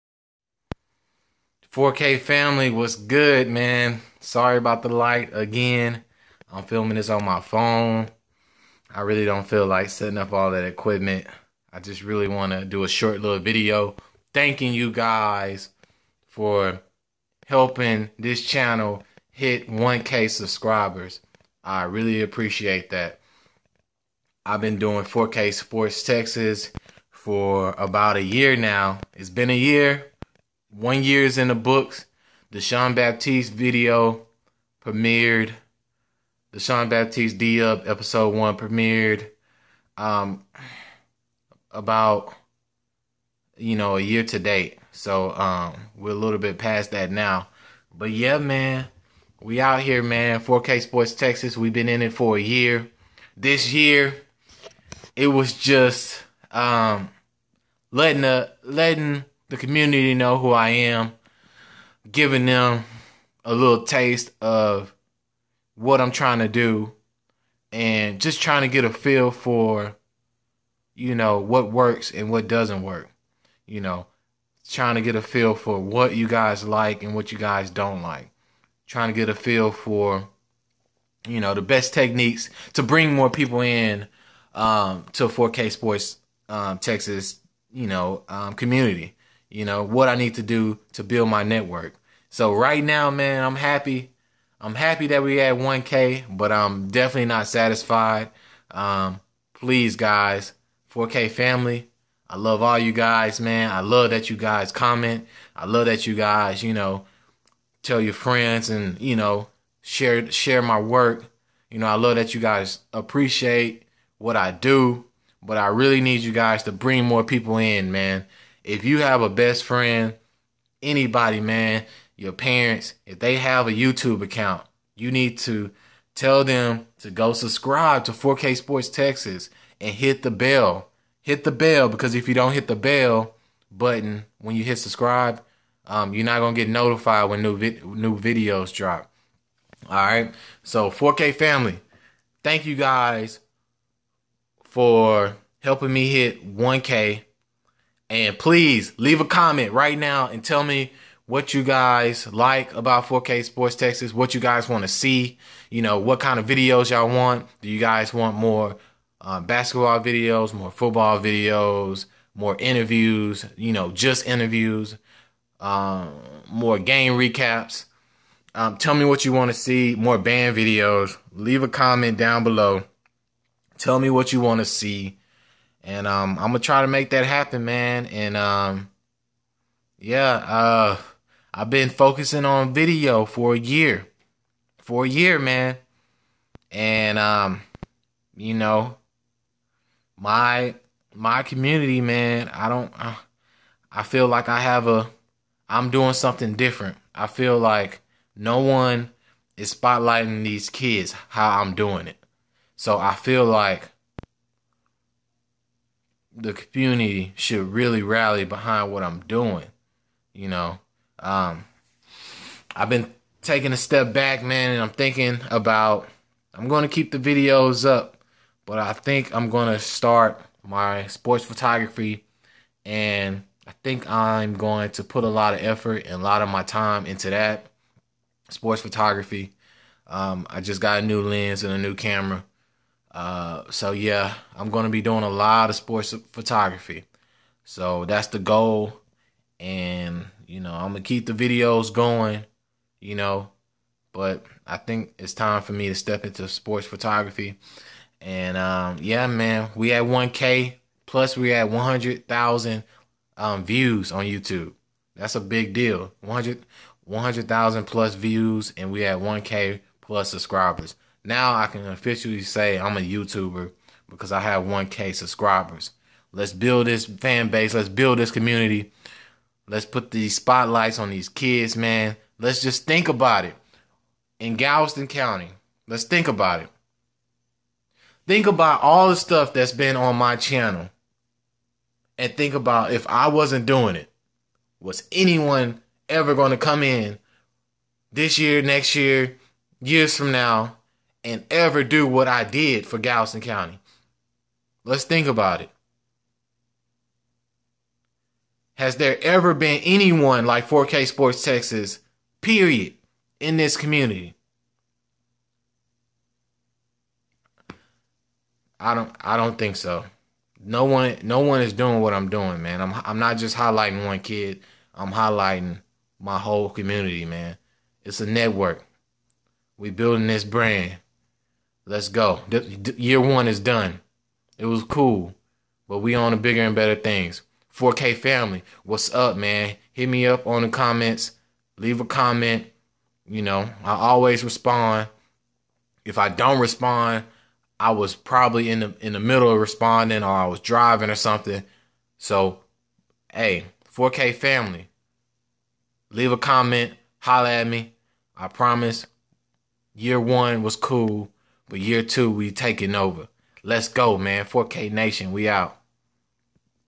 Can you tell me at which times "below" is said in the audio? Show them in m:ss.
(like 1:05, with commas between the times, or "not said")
2:52.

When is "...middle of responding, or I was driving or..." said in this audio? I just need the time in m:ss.
5:39.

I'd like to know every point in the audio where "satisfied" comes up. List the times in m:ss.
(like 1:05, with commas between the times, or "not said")
1:37.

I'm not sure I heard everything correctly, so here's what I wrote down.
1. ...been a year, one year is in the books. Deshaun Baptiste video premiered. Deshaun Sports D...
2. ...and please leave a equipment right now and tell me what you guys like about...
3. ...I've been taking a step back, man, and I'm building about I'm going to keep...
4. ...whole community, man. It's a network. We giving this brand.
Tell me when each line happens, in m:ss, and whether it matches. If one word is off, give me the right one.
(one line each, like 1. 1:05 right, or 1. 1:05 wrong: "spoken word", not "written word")
1. 0:29 wrong: "Baptiste", not "Sports"
2. 2:28 wrong: "comment", not "equipment"
3. 3:32 wrong: "thinking", not "building"
4. 5:16 wrong: "building", not "giving".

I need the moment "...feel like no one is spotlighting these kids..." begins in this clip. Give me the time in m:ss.
3:17.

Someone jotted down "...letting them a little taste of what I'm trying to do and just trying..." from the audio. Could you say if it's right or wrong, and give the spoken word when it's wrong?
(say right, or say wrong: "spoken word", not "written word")
wrong: "giving", not "letting".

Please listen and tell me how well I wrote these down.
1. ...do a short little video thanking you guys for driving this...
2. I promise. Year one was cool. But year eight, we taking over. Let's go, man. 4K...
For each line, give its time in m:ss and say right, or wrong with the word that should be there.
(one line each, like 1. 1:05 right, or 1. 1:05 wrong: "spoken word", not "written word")
1. 0:12 wrong: "helping", not "driving"
2. 5:48 wrong: "two", not "eight".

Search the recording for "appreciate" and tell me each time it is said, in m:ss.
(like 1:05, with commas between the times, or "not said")
0:22, 1:52.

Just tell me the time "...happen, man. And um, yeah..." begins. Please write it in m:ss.
2:57.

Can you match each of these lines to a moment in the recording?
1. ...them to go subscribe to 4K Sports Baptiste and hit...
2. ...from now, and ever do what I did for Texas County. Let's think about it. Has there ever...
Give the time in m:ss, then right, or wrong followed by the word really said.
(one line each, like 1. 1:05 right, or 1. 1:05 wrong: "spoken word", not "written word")
1. 2:06 wrong: "Texas", not "Baptiste"
2. 4:50 wrong: "Galveston", not "Texas".